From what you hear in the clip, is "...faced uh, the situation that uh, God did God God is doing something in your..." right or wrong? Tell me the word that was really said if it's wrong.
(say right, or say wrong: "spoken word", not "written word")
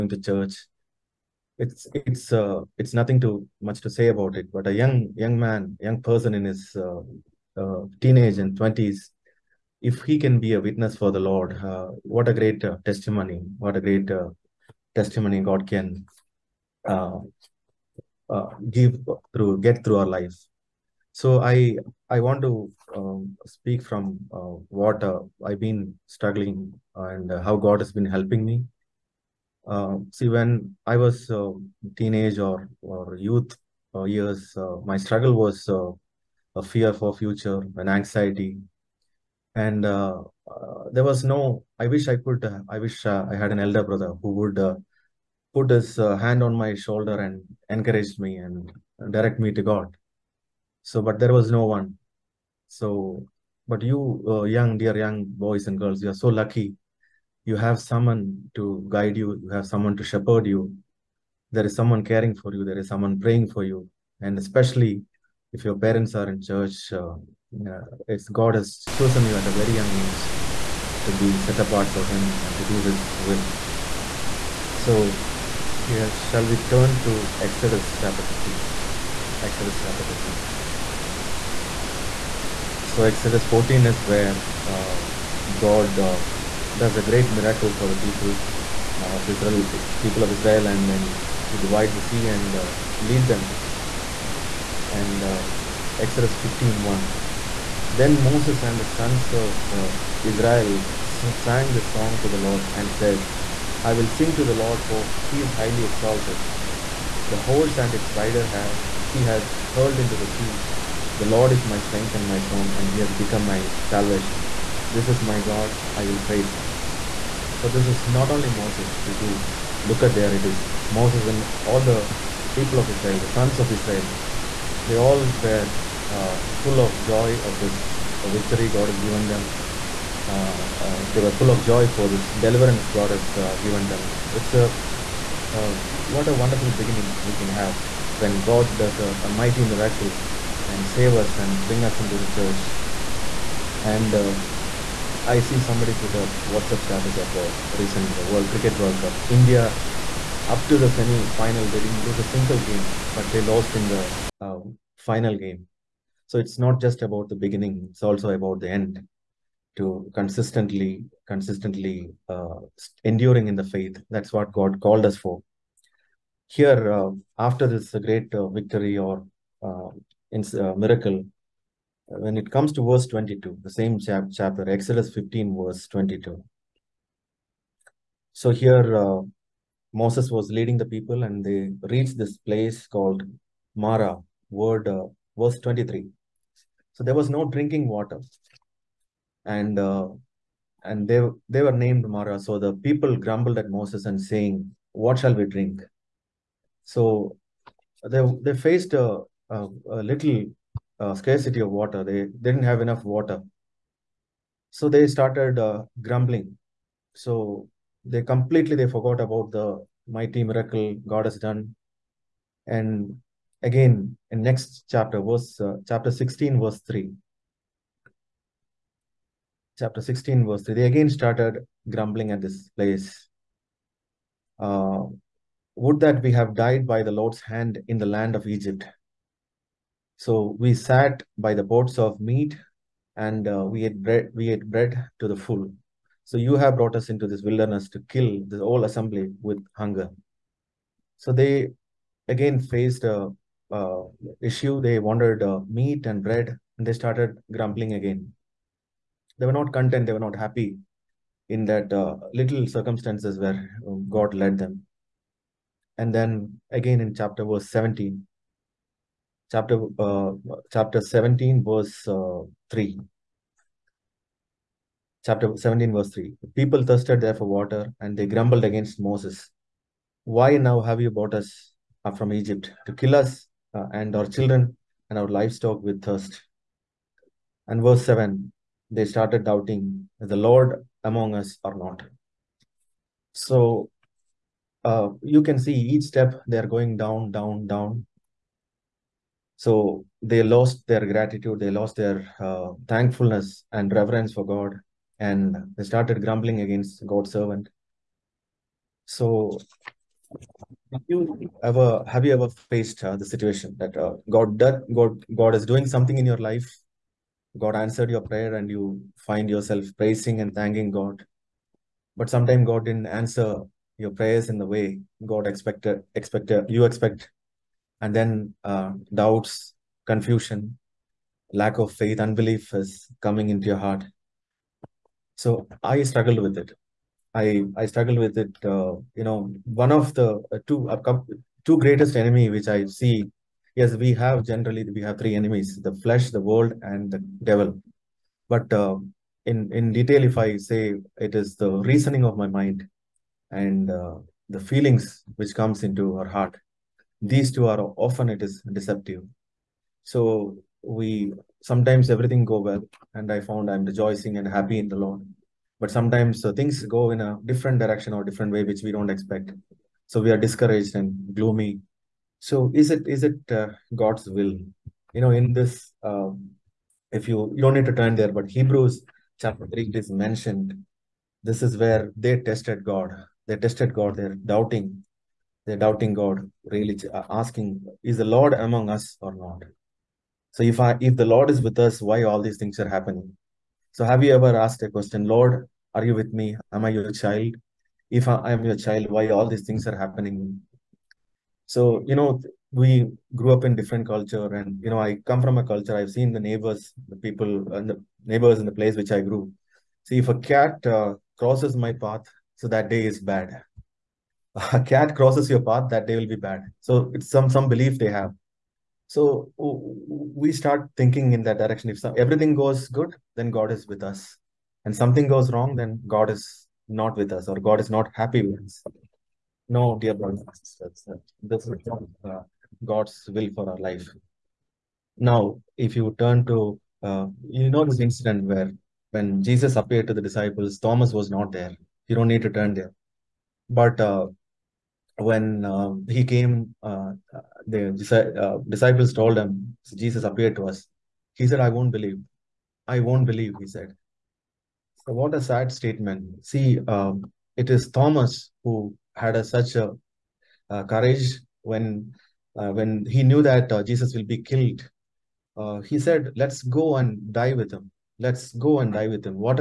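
right.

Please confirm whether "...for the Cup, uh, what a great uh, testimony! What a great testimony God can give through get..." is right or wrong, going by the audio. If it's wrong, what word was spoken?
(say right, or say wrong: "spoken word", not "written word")
wrong: "Lord", not "Cup".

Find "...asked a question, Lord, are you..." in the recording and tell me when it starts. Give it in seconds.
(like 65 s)
384 s.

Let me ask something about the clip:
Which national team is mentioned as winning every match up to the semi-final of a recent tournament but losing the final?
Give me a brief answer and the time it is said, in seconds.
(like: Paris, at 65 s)
India, at 149 s.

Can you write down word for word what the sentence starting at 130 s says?
Uh, uh, they were full of joy for this deliverance God has uh, given them.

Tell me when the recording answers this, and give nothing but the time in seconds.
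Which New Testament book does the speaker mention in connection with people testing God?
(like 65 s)
368 s.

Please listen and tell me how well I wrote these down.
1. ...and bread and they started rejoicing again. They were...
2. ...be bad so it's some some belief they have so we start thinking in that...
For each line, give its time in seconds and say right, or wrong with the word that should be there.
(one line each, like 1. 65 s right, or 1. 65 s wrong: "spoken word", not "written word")
1. 246 s wrong: "grumbling", not "rejoicing"
2. 406 s right.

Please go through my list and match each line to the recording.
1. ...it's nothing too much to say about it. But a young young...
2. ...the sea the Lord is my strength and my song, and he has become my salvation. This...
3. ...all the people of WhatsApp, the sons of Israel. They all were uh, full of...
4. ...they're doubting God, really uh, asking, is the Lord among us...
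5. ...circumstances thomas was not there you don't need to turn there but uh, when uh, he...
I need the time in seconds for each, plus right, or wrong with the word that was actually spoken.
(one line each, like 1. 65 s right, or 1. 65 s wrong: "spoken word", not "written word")
1. 2 s right
2. 110 s right
3. 121 s wrong: "Israel", not "WhatsApp"
4. 375 s right
5. 430 s wrong: "disciples", not "circumstances".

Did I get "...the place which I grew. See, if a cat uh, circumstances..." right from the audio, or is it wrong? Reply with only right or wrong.
wrong.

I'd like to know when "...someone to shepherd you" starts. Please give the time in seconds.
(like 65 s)
59 s.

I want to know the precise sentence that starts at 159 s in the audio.
To consistently, consistently uh, enduring in the faith.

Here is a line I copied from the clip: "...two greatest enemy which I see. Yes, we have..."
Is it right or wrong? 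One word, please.
right.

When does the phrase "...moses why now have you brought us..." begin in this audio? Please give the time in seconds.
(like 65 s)
269 s.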